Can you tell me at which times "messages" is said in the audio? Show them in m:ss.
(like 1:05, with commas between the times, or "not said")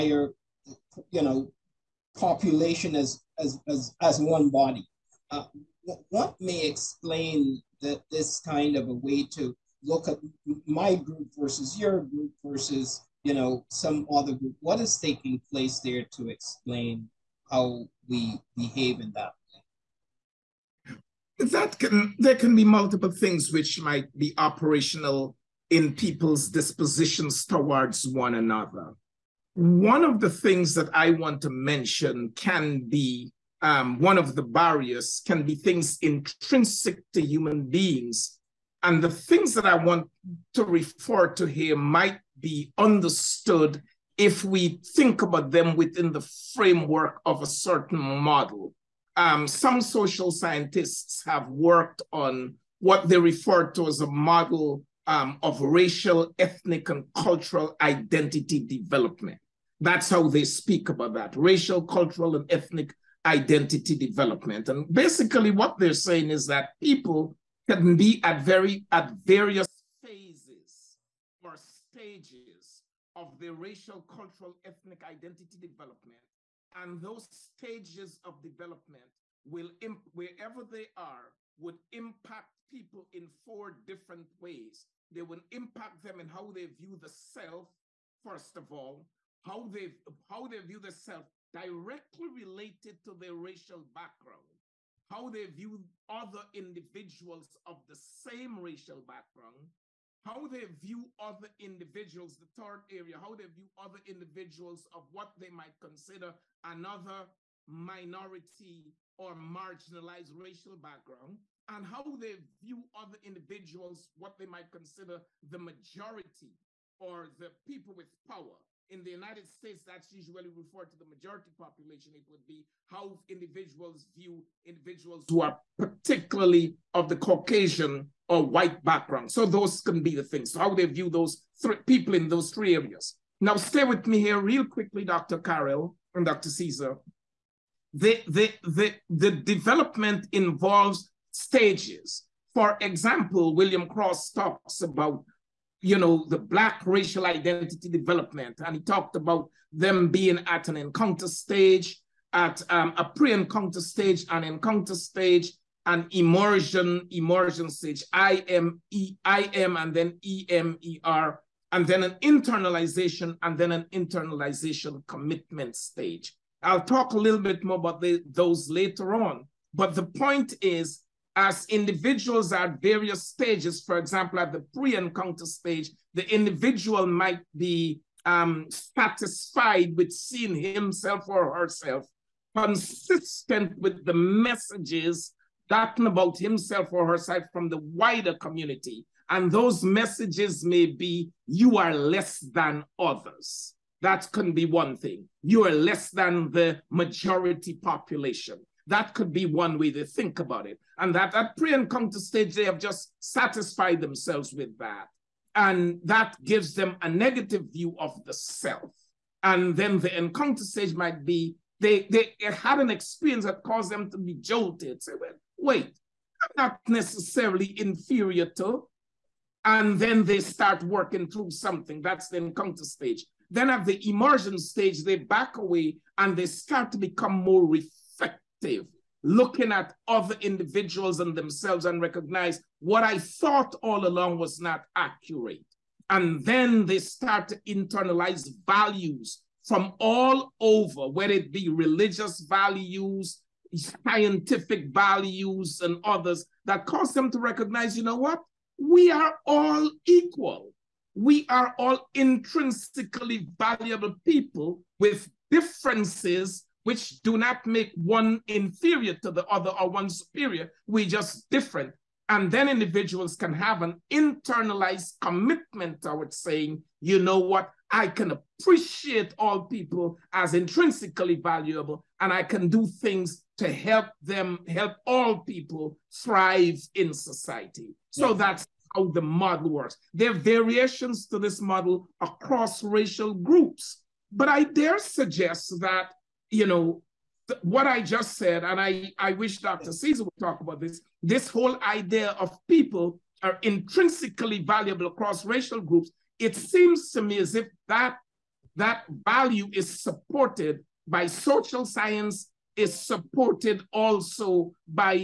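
3:04, 3:09.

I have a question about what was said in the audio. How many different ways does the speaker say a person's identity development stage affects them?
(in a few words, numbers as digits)
4.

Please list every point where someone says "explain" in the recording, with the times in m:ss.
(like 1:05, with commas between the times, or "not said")
0:06, 0:16.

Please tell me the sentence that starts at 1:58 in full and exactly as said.
In the United States, that's usually referred to the majority population.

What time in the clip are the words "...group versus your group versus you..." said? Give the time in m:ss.
0:10.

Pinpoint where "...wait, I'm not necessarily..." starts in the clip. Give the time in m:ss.
3:35.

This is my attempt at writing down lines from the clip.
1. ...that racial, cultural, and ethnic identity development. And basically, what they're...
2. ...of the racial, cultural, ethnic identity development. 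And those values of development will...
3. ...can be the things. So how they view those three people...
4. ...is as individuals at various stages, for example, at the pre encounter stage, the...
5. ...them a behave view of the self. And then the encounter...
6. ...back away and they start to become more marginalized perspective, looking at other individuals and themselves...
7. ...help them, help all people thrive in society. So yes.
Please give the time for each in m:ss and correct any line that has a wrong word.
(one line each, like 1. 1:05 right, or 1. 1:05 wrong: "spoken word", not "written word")
1. 1:01 right
2. 1:13 wrong: "stages", not "values"
3. 2:09 right
4. 2:50 right
5. 3:26 wrong: "negative", not "behave"
6. 3:45 wrong: "refined", not "marginalized"
7. 4:33 right.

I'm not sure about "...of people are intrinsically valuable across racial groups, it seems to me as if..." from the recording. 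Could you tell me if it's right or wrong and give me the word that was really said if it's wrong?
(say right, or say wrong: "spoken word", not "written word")
right.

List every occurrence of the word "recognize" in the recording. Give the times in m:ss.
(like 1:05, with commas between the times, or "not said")
3:52, 4:07.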